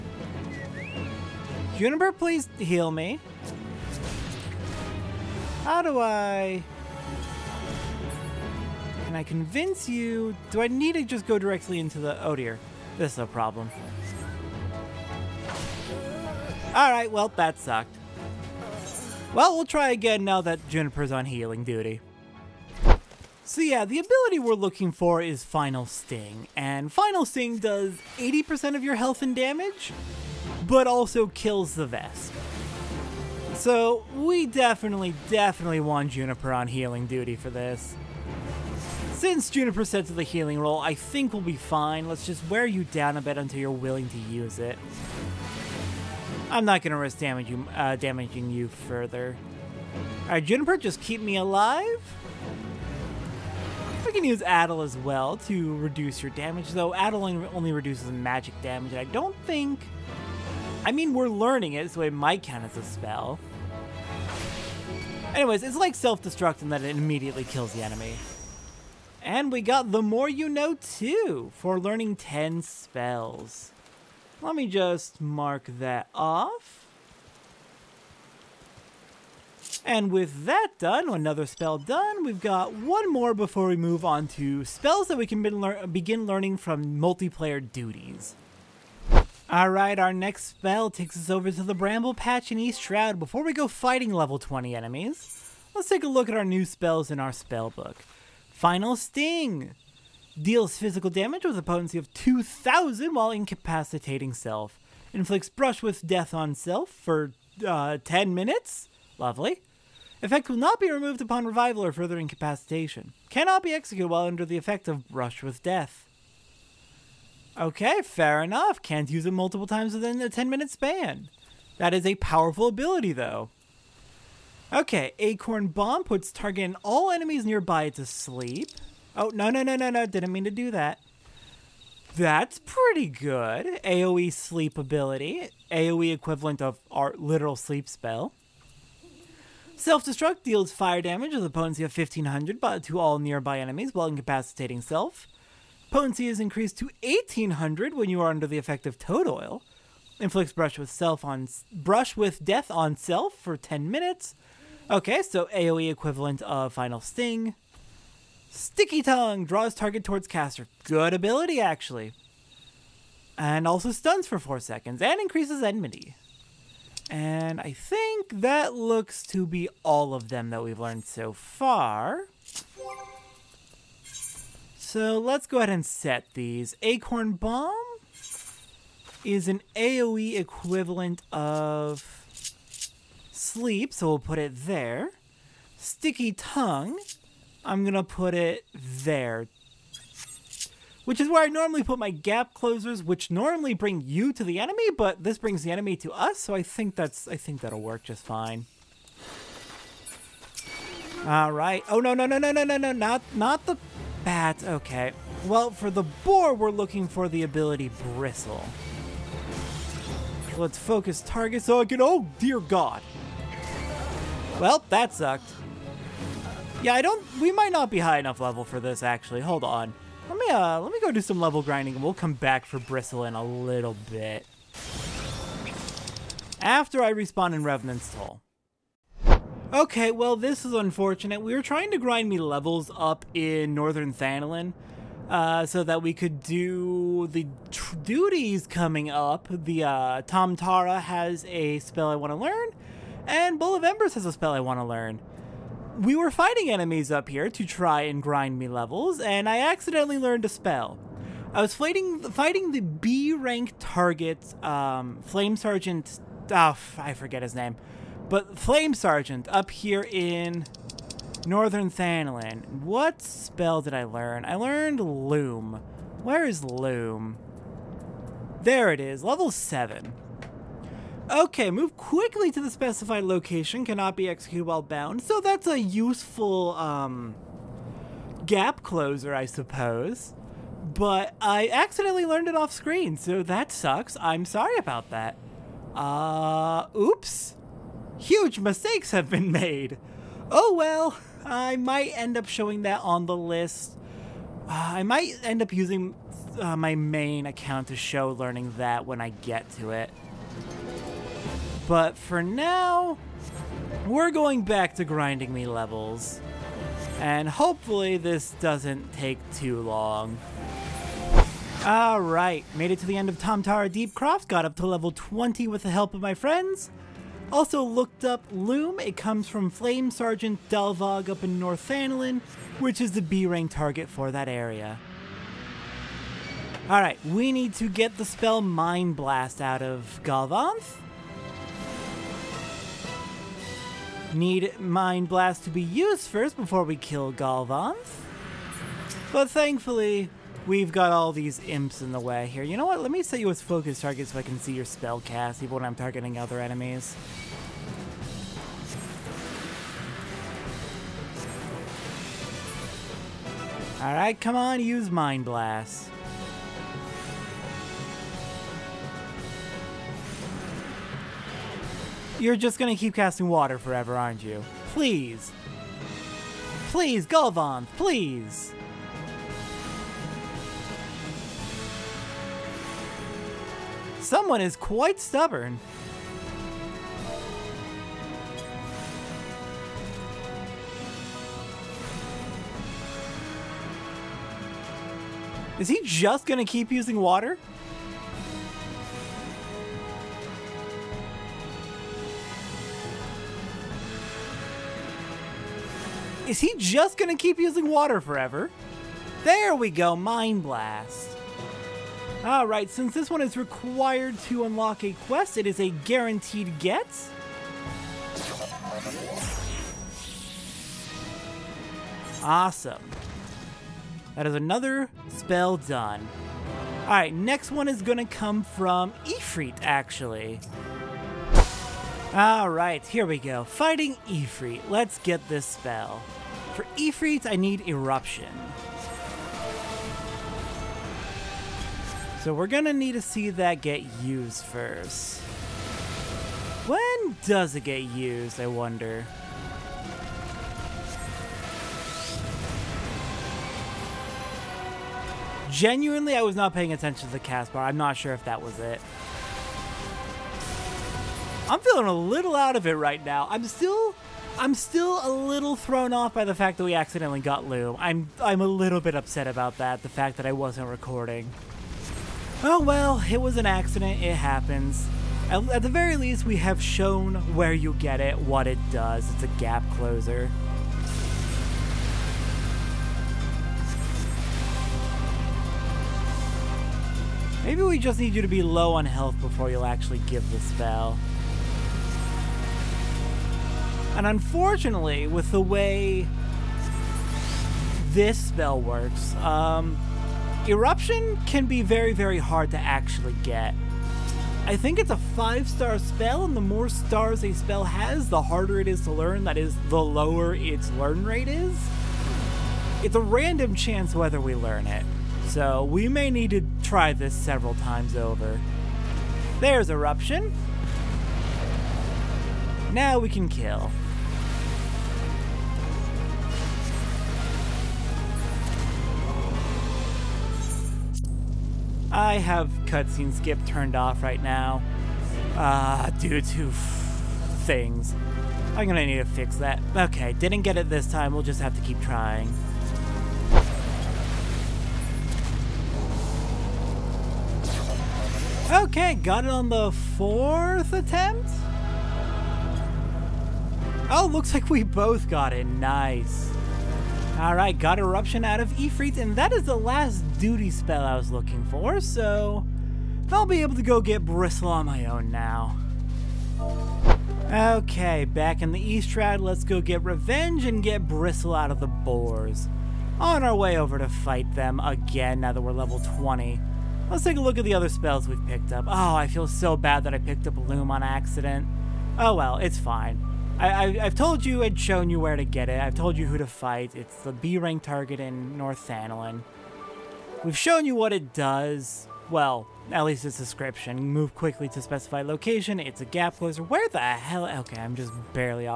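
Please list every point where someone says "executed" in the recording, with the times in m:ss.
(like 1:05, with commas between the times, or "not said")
1:53, 4:34.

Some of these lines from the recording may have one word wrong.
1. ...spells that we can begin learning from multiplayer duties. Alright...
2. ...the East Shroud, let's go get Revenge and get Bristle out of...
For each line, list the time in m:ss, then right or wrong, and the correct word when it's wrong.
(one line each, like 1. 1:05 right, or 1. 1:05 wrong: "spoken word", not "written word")
1. 1:24 right
2. 9:18 right.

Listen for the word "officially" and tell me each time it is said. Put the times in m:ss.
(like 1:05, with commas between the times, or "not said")
not said.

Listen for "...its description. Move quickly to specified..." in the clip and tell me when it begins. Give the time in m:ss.
9:43.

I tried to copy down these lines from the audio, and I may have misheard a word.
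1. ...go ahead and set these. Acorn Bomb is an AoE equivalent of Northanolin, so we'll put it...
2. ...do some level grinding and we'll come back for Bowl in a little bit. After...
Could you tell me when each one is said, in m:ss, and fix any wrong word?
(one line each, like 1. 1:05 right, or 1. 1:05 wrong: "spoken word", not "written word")
1. 2:55 wrong: "Sleep", not "Northanolin"
2. 3:41 wrong: "Bristle", not "Bowl".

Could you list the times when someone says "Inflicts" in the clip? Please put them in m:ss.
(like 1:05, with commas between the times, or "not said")
1:45, 2:30.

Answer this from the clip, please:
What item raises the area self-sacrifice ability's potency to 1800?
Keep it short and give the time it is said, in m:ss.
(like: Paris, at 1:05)
toad oil, at 2:28.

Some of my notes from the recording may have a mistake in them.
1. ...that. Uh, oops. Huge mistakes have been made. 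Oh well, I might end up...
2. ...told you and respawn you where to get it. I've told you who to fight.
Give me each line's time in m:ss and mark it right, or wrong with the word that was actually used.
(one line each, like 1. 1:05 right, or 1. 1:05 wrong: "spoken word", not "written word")
1. 4:45 right
2. 9:34 wrong: "shown", not "respawn".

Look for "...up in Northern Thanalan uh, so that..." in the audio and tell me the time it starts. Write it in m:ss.
3:52.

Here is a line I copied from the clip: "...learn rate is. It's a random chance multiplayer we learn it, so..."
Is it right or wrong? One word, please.
wrong.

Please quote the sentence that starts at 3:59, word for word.
The uh, Tam-Tara has a spell I want to learn, and Bowl of Embers has a spell I want to learn.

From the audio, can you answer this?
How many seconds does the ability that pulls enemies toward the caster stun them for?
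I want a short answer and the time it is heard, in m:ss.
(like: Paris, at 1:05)
4, at 2:44.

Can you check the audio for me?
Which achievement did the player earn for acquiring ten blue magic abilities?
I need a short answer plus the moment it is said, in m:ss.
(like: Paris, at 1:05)
The More You Know, at 1:09.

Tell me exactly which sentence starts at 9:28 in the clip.
Oh, I feel so bad that I picked up Loom on accident.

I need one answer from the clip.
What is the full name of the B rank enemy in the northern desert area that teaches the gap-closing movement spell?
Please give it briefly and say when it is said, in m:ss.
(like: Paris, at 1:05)
Flame Sergeant Dalvag, at 5:19.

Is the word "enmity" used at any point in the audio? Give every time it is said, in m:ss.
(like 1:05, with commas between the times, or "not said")
2:45.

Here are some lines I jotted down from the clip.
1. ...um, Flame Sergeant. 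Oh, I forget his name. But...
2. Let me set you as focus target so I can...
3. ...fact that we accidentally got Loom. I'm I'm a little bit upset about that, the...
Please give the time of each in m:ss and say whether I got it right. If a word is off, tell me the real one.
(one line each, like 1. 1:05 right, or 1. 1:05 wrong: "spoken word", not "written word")
1. 4:14 right
2. 5:43 right
3. 7:36 right.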